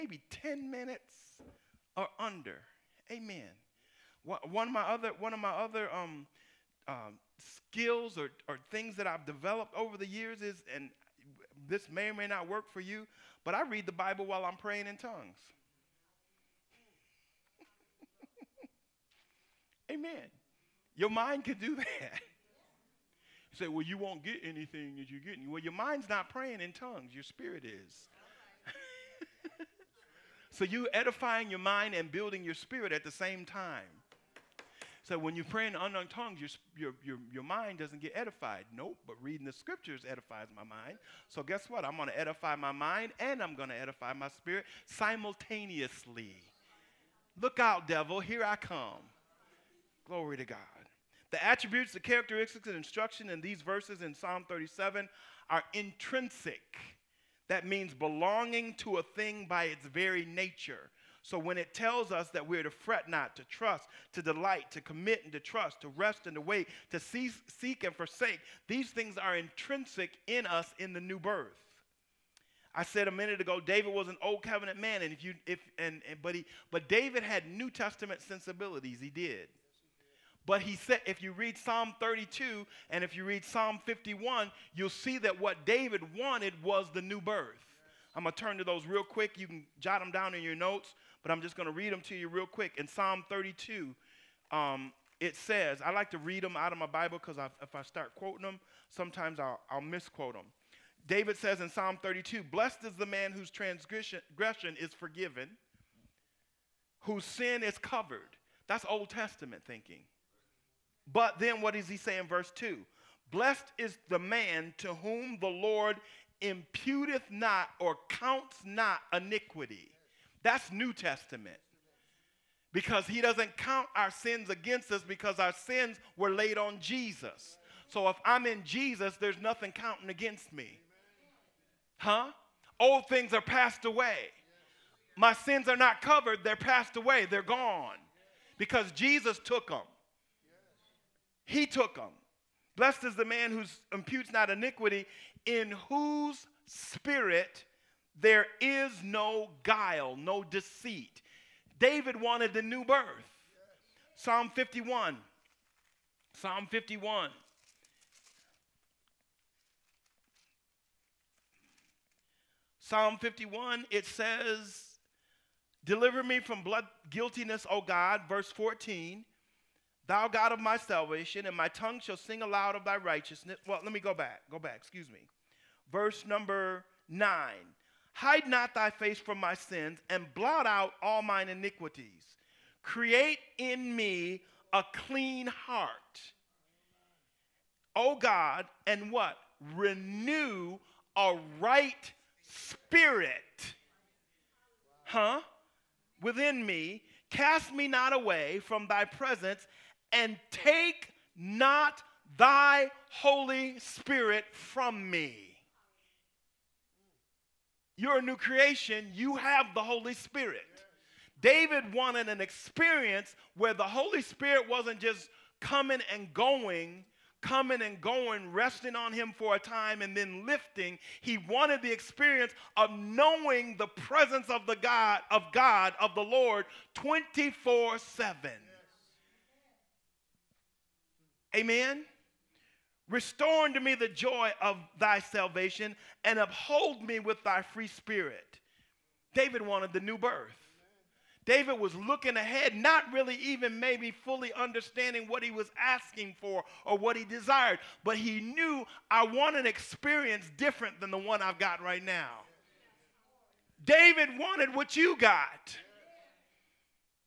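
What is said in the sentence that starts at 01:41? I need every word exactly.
David says in Psalm 32, Blessed is the man whose transgression is forgiven, whose sin is covered.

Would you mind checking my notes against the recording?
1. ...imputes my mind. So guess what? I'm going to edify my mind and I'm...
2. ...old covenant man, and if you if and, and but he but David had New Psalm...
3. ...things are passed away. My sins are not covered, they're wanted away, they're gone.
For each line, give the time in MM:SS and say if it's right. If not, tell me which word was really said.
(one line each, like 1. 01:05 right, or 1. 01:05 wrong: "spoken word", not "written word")
1. 00:40 wrong: "edifies", not "imputes"
2. 01:14 wrong: "Testament", not "Psalm"
3. 02:13 wrong: "passed", not "wanted".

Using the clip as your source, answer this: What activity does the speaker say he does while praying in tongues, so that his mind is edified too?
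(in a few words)
Read the Bible.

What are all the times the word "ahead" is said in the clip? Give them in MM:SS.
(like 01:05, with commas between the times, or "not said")
04:02.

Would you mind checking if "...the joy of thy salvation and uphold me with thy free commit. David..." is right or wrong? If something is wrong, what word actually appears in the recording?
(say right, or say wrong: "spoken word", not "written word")
wrong: "spirit", not "commit".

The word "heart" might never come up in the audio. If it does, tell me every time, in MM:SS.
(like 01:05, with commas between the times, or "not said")
03:05.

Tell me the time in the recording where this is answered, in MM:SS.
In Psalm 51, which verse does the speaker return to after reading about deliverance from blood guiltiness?
02:55.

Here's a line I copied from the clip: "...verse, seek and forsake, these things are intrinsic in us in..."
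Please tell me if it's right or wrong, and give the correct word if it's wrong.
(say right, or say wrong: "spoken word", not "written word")
wrong: "cease", not "verse".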